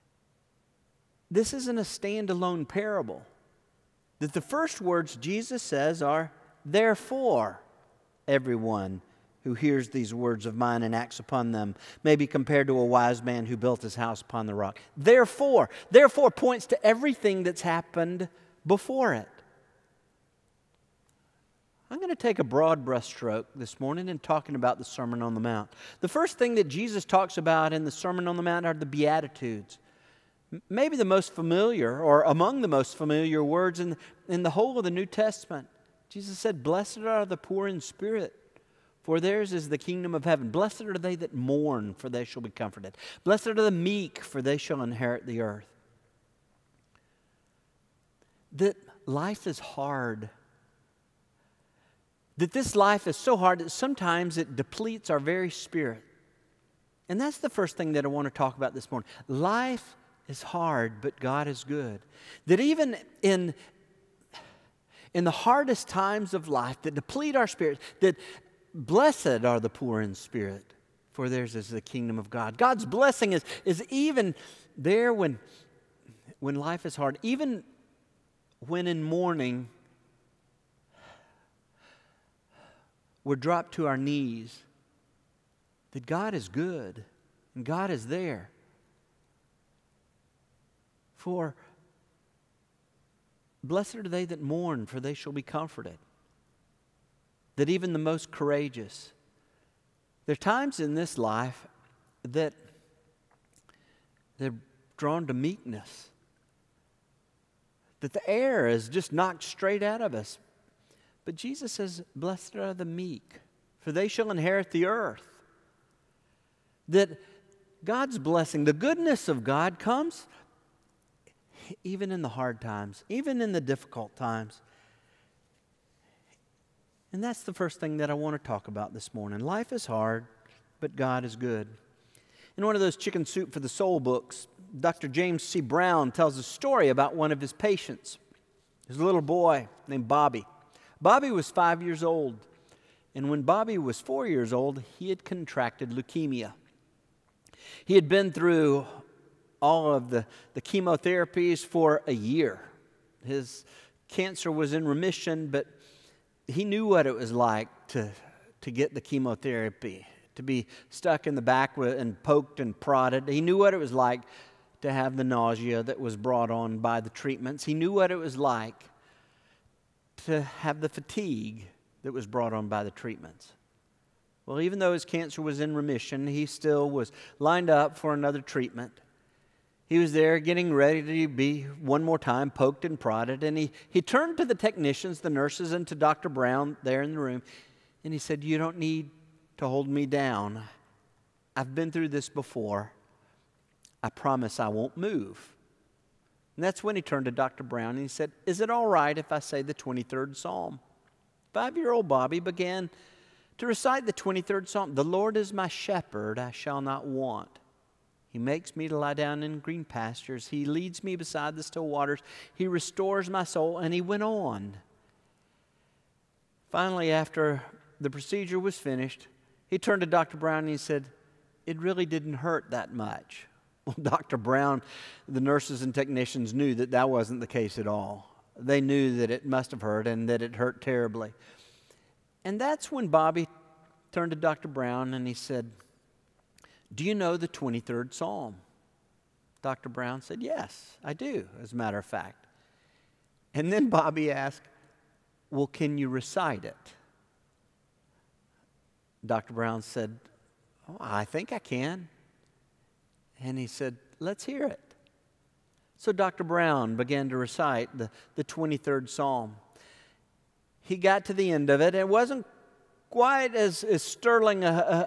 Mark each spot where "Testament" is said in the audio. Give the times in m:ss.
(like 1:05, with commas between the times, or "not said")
0:35.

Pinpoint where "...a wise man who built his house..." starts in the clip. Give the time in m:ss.
0:12.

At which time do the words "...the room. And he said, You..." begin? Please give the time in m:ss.
3:07.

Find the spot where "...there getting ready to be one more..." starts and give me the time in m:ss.
3:00.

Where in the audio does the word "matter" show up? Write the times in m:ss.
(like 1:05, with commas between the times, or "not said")
4:01.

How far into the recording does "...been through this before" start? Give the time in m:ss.
3:11.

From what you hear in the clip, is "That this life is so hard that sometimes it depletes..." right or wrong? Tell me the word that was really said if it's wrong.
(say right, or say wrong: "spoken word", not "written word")
right.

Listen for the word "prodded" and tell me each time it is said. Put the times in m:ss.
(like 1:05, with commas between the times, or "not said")
2:42, 3:02.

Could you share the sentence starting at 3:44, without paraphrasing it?
Brown, the nurses and technicians knew that that wasn't the case at all.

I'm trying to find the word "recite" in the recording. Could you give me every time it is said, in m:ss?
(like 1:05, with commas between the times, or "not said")
3:23, 4:06, 4:17.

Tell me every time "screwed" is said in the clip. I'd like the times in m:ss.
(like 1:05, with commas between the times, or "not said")
not said.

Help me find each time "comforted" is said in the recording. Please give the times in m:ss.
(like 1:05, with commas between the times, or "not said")
0:42, 1:35.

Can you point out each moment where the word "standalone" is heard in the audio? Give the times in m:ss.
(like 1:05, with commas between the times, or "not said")
0:01.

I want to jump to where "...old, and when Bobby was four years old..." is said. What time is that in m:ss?
2:22.